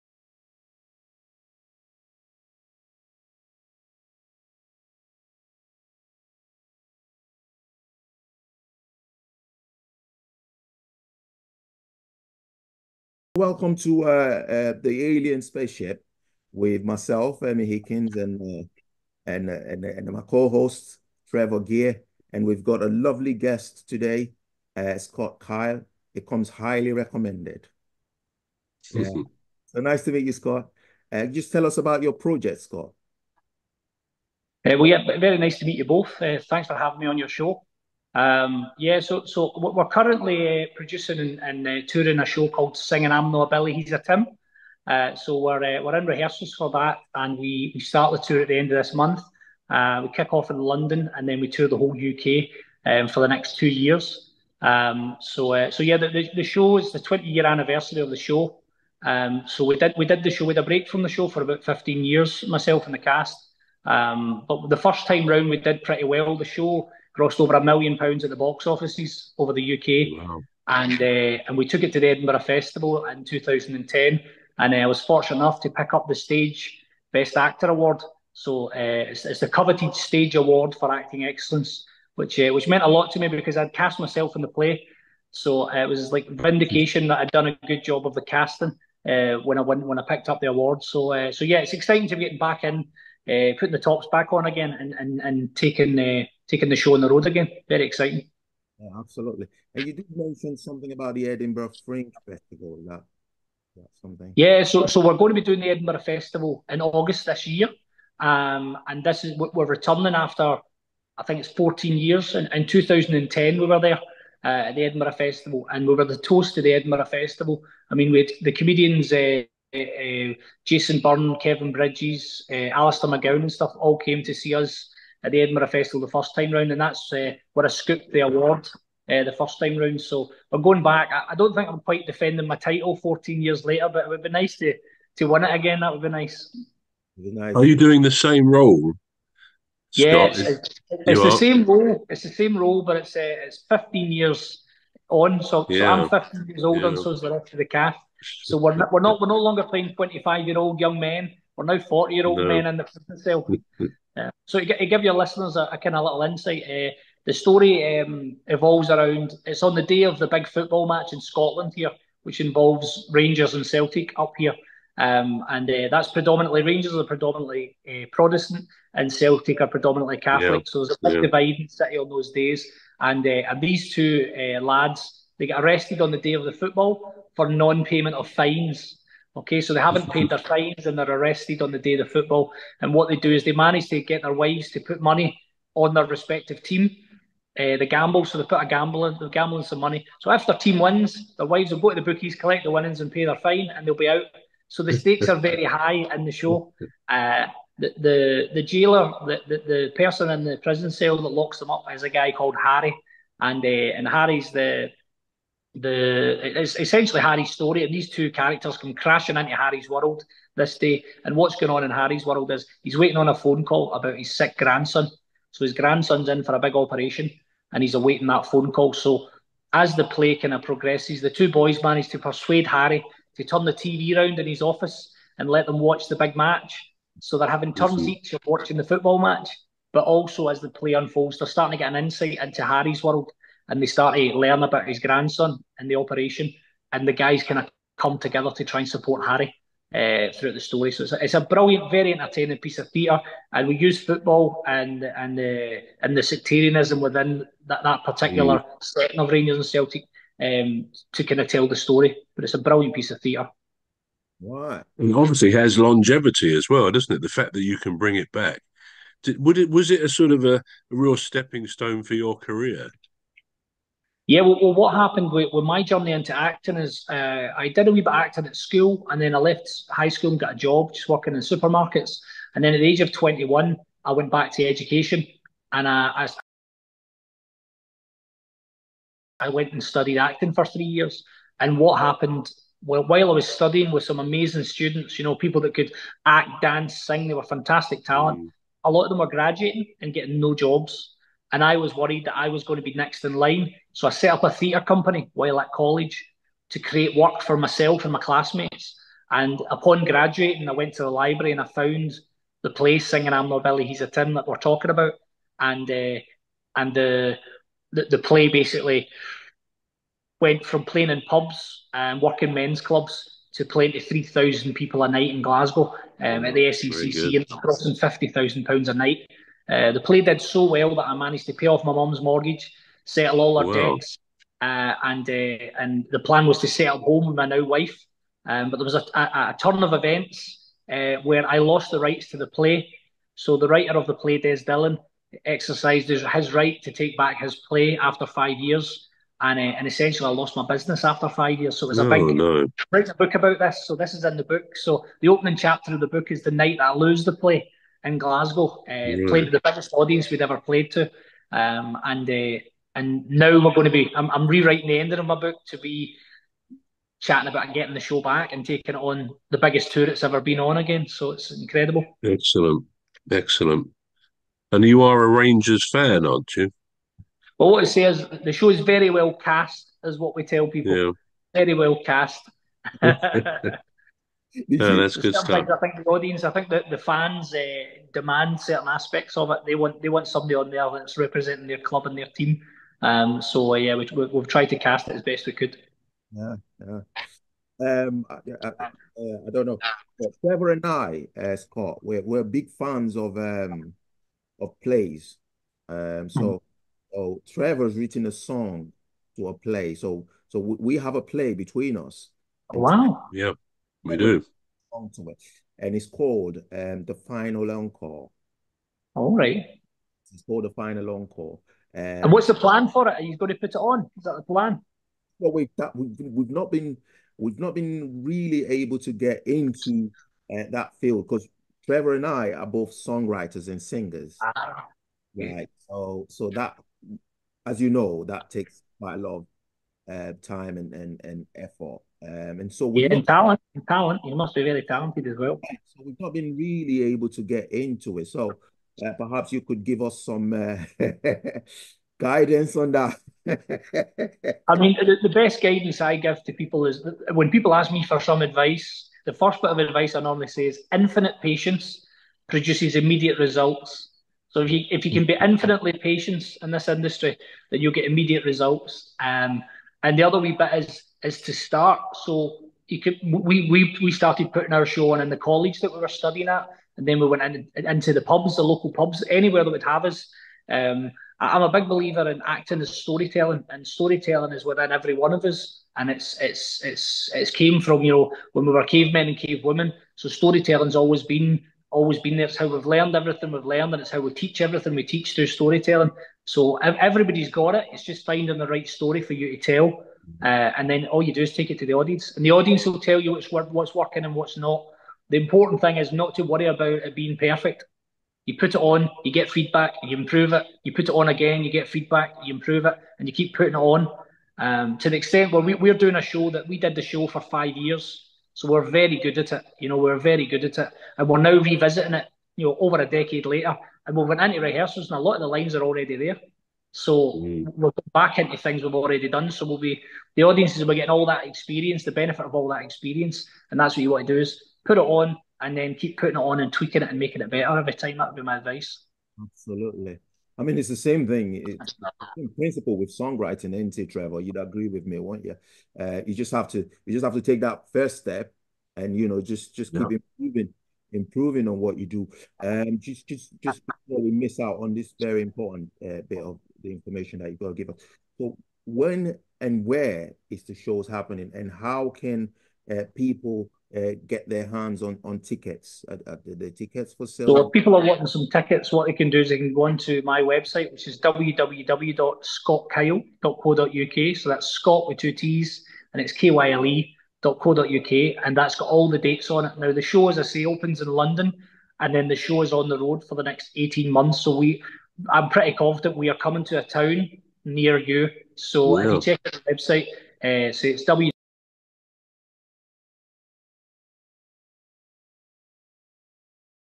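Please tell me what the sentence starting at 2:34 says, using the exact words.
Uh, so to, to, give your listeners a, a kind of little insight, uh, the story um, evolves around.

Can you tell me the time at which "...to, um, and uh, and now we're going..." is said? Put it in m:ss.
5:50.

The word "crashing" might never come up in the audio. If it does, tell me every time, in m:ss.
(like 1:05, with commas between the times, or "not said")
3:28.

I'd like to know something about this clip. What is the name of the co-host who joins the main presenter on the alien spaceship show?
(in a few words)
Trevor Gear.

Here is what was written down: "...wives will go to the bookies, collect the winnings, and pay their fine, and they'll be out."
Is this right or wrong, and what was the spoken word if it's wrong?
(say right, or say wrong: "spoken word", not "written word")
right.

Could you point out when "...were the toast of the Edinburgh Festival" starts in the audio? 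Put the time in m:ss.
1:55.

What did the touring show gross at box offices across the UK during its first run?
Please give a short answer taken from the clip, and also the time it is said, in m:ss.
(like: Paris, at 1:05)
over a million pounds, at 1:07.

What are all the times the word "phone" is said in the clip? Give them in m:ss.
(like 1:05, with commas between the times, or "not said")
3:33, 3:38.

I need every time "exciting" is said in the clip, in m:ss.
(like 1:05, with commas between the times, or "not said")
1:31, 1:37.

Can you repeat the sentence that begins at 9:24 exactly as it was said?
So that's Scott with two T's, and it's K Y L E .co.uk, and that's got all the dates on it.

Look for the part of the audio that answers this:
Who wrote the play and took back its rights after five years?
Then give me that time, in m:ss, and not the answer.
5:34.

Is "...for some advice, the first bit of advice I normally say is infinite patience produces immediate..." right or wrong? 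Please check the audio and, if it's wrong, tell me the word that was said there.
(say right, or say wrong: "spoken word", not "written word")
right.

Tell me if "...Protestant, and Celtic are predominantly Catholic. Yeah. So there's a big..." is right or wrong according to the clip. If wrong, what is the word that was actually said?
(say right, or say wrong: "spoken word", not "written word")
right.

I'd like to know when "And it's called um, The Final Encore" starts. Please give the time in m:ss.
6:45.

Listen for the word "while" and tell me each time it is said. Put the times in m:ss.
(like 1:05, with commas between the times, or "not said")
4:43, 4:55.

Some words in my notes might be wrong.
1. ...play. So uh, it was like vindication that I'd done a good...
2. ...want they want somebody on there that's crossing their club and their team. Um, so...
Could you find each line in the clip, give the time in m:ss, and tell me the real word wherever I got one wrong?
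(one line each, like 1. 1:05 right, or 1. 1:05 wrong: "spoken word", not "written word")
1. 1:24 right
2. 6:19 wrong: "representing", not "crossing".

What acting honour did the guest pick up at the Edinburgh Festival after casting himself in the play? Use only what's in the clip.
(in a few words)
Stage Best Actor Award.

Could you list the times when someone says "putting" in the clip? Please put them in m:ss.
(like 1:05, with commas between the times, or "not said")
1:33, 7:44, 8:23, 8:46.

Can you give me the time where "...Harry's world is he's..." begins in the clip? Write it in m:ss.
3:31.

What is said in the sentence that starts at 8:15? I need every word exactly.
The important thing is not to worry about it being perfect.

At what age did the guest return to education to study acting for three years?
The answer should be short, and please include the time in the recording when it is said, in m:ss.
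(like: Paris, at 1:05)
21, at 4:33.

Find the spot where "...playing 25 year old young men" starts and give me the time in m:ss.
2:29.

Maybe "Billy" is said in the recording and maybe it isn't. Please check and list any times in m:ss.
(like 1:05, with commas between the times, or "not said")
0:43, 5:03.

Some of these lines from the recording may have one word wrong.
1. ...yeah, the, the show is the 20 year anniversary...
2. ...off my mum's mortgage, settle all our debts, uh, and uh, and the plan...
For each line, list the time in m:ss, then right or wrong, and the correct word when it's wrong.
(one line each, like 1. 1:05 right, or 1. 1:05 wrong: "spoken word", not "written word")
1. 0:55 right
2. 5:21 right.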